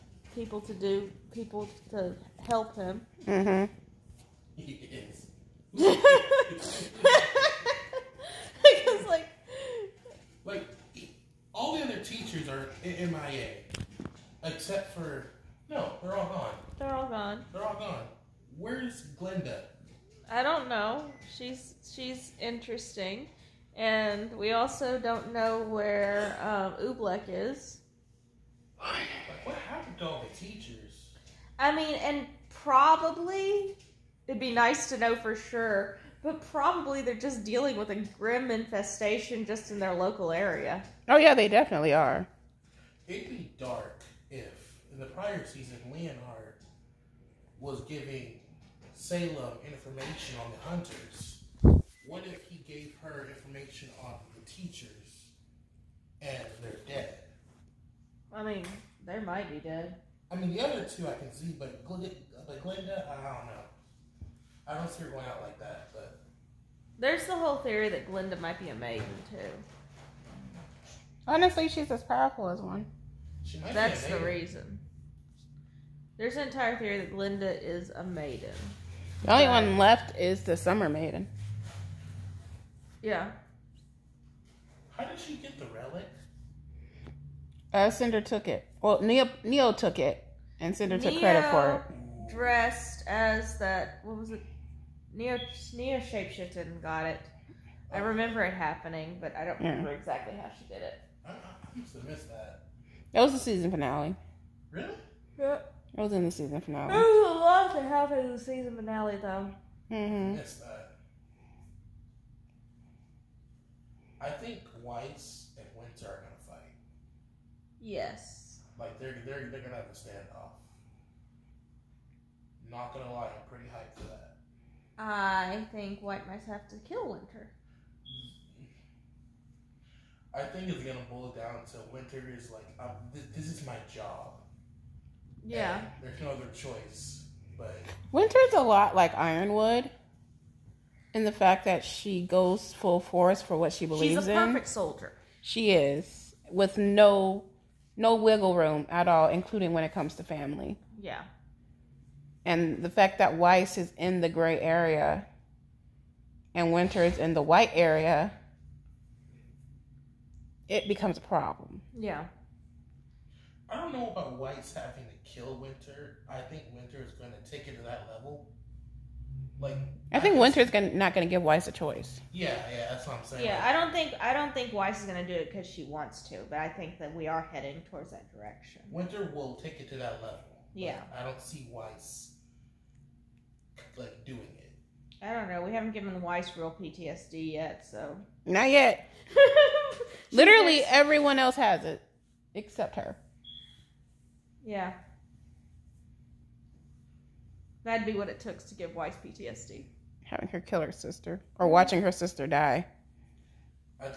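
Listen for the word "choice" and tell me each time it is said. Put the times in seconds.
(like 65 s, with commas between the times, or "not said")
136 s, 171 s.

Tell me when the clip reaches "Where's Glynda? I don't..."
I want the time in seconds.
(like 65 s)
18 s.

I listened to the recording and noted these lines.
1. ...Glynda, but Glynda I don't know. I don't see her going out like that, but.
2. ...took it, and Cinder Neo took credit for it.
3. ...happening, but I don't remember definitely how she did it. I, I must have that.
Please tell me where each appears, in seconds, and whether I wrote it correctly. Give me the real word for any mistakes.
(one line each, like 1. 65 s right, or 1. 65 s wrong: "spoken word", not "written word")
1. 61 s right
2. 89 s right
3. 98 s wrong: "exactly", not "definitely".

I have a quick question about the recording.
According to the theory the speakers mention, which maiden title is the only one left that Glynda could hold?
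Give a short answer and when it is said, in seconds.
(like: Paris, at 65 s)
Summer Maiden, at 80 s.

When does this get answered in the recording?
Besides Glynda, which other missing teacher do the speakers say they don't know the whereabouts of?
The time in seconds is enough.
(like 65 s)
26 s.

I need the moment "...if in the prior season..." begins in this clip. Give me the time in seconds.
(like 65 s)
44 s.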